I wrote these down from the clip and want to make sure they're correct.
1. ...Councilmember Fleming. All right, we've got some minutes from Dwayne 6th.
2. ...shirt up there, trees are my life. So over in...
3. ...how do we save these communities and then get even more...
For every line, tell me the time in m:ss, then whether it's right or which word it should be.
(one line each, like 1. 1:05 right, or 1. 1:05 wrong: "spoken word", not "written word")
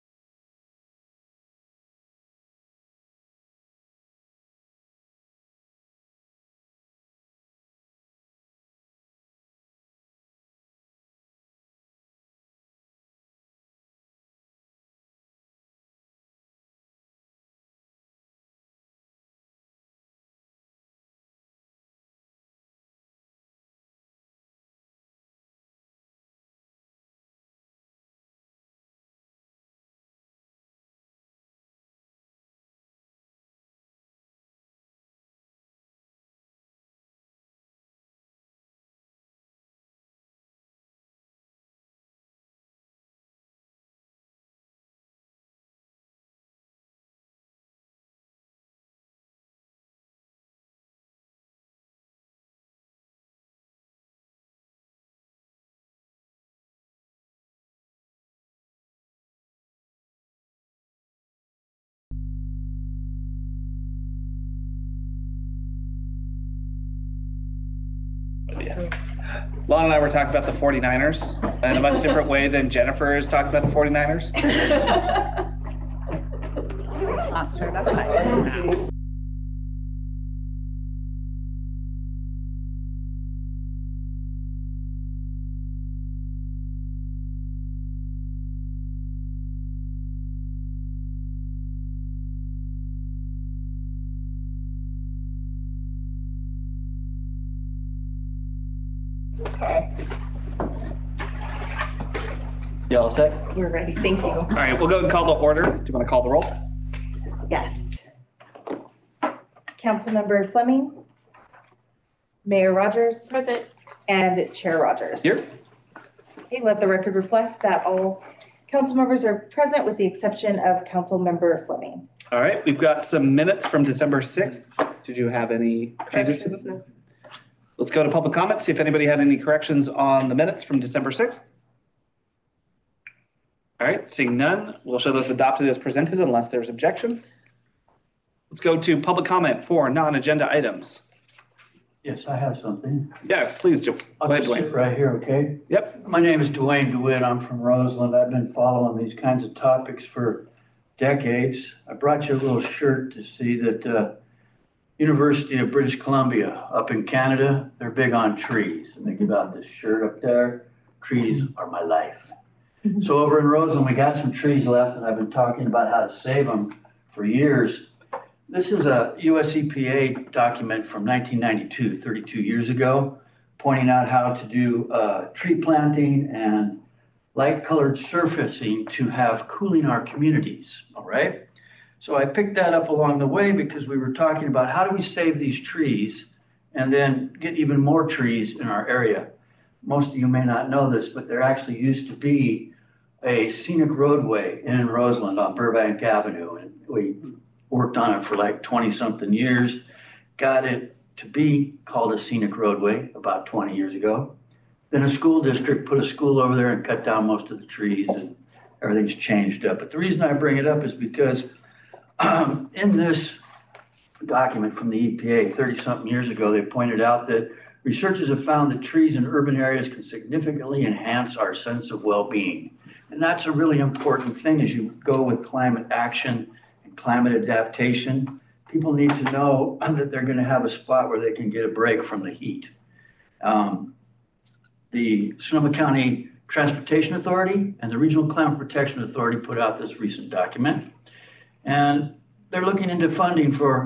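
1. 2:00 wrong: "December", not "Dwayne"
2. 2:39 right
3. 3:04 wrong: "trees", not "communities".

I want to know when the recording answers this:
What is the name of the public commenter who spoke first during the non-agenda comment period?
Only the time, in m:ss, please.
2:26.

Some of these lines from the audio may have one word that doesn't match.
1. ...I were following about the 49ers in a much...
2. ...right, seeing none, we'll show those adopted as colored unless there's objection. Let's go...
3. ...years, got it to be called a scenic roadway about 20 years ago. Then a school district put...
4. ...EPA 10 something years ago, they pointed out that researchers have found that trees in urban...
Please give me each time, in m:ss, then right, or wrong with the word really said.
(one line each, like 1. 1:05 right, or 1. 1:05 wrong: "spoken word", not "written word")
1. 1:09 wrong: "talking", not "following"
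2. 2:13 wrong: "presented", not "colored"
3. 3:19 right
4. 3:35 wrong: "30", not "10".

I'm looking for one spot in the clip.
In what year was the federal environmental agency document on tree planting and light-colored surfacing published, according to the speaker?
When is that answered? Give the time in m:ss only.
2:51.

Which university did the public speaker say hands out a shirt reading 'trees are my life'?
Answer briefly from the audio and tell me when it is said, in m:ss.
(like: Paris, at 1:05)
University of British Columbia, at 2:34.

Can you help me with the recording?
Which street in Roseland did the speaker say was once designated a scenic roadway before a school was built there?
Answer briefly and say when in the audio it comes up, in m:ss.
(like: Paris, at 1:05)
Burbank Avenue, at 3:15.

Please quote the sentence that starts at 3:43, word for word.
And that's a really important thing as you go with climate action and climate adaptation.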